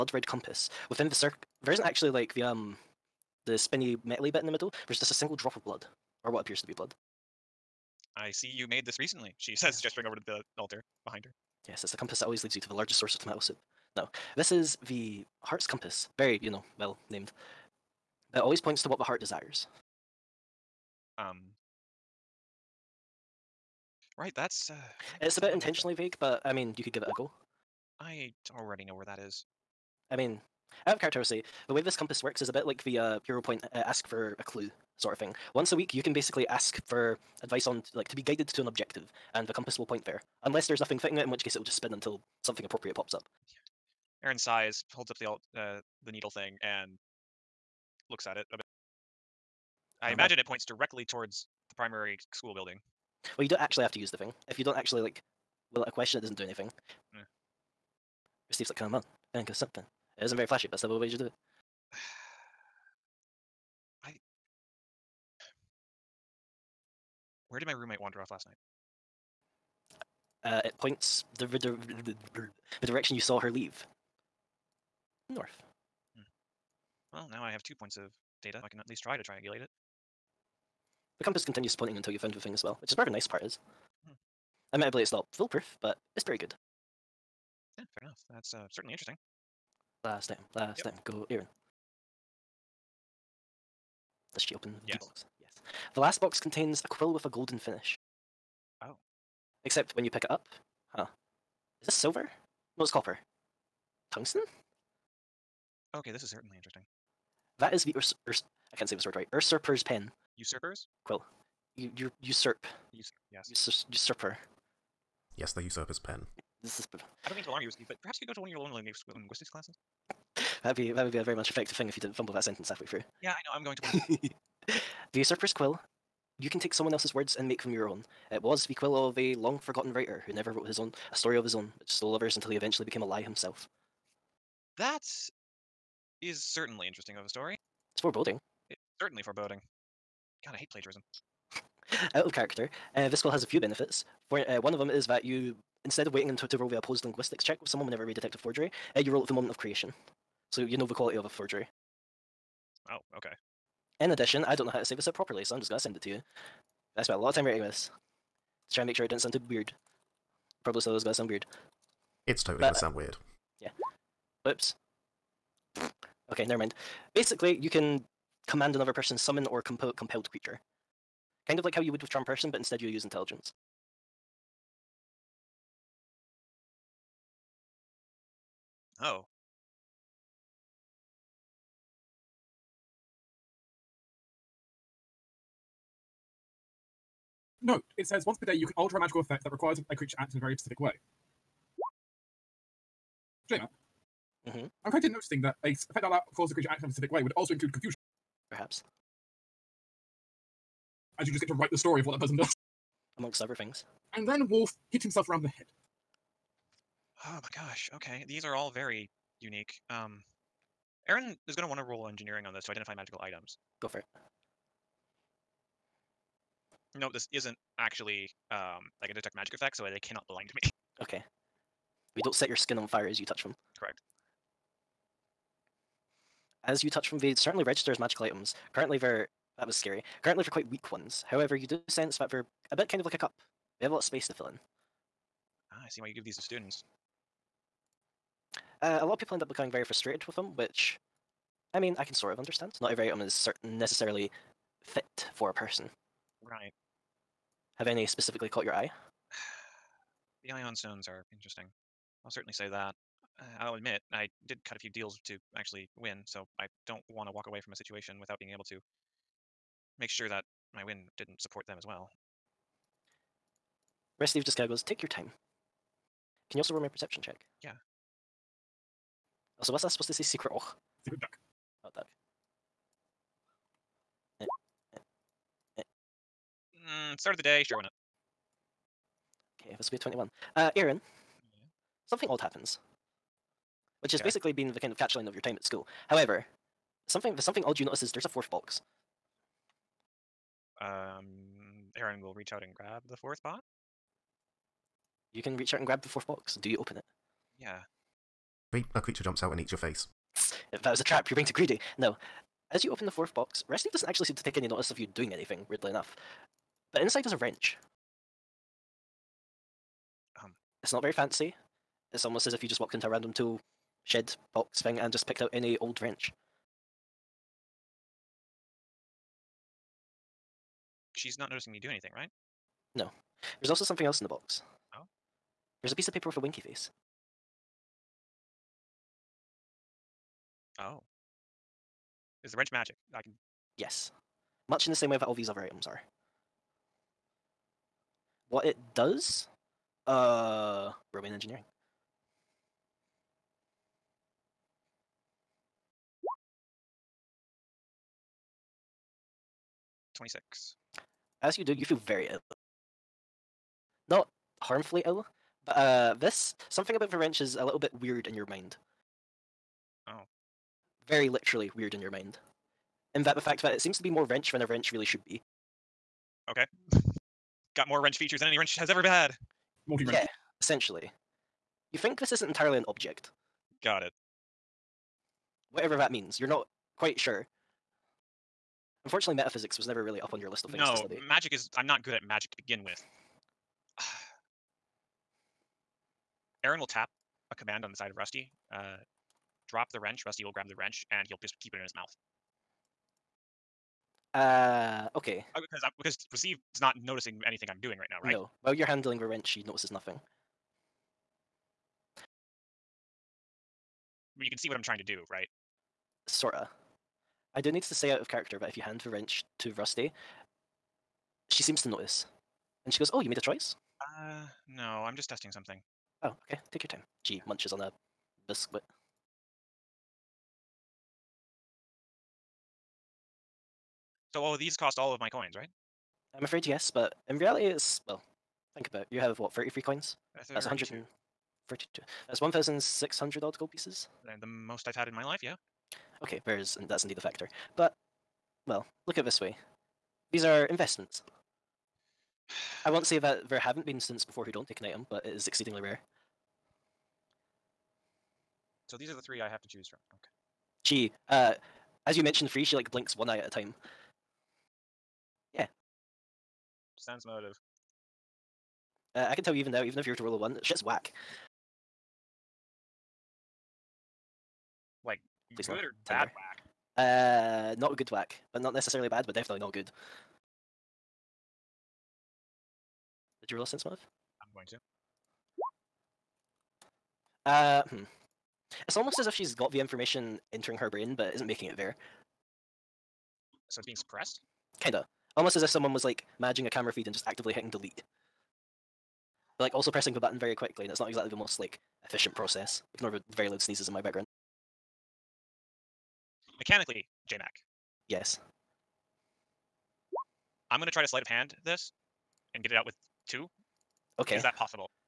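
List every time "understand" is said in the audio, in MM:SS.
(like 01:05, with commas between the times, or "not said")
04:02.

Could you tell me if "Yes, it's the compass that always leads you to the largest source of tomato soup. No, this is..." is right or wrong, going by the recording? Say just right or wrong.
right.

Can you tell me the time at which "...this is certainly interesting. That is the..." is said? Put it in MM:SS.
01:46.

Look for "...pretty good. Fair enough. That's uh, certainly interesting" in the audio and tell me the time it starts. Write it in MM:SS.
01:26.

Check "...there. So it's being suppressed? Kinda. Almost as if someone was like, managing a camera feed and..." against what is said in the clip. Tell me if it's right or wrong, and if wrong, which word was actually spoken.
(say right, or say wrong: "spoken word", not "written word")
right.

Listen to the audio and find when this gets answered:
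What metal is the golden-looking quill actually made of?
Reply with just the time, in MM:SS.
01:42.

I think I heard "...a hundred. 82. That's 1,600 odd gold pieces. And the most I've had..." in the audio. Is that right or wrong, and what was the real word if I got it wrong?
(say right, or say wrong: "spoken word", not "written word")
wrong: "32", not "82".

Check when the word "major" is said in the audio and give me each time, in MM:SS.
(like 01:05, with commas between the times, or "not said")
not said.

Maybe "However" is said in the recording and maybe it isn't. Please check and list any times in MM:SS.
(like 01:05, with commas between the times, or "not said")
03:51, 04:46.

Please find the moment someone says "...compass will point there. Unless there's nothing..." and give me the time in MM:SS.
00:39.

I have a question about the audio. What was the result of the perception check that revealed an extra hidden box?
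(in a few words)
21.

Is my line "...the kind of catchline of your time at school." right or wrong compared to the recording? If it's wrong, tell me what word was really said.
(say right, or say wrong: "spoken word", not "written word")
right.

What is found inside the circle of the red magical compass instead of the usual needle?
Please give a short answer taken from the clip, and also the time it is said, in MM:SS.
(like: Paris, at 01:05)
A single drop of blood, at 00:05.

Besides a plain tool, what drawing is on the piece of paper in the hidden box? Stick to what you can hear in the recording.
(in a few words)
A winky face.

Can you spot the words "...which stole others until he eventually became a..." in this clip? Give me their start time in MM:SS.
02:11.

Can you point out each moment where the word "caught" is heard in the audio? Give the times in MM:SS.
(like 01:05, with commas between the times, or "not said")
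04:08.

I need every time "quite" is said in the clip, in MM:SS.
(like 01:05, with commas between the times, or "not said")
03:14, 03:50, 06:16.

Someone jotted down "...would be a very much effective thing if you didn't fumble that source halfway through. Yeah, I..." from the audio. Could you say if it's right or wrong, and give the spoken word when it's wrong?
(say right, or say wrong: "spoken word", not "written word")
wrong: "sentence", not "source".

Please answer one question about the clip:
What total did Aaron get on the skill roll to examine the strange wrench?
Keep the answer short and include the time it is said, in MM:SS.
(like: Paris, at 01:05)
26, at 05:50.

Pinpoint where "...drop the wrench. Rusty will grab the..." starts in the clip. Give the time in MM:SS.
06:29.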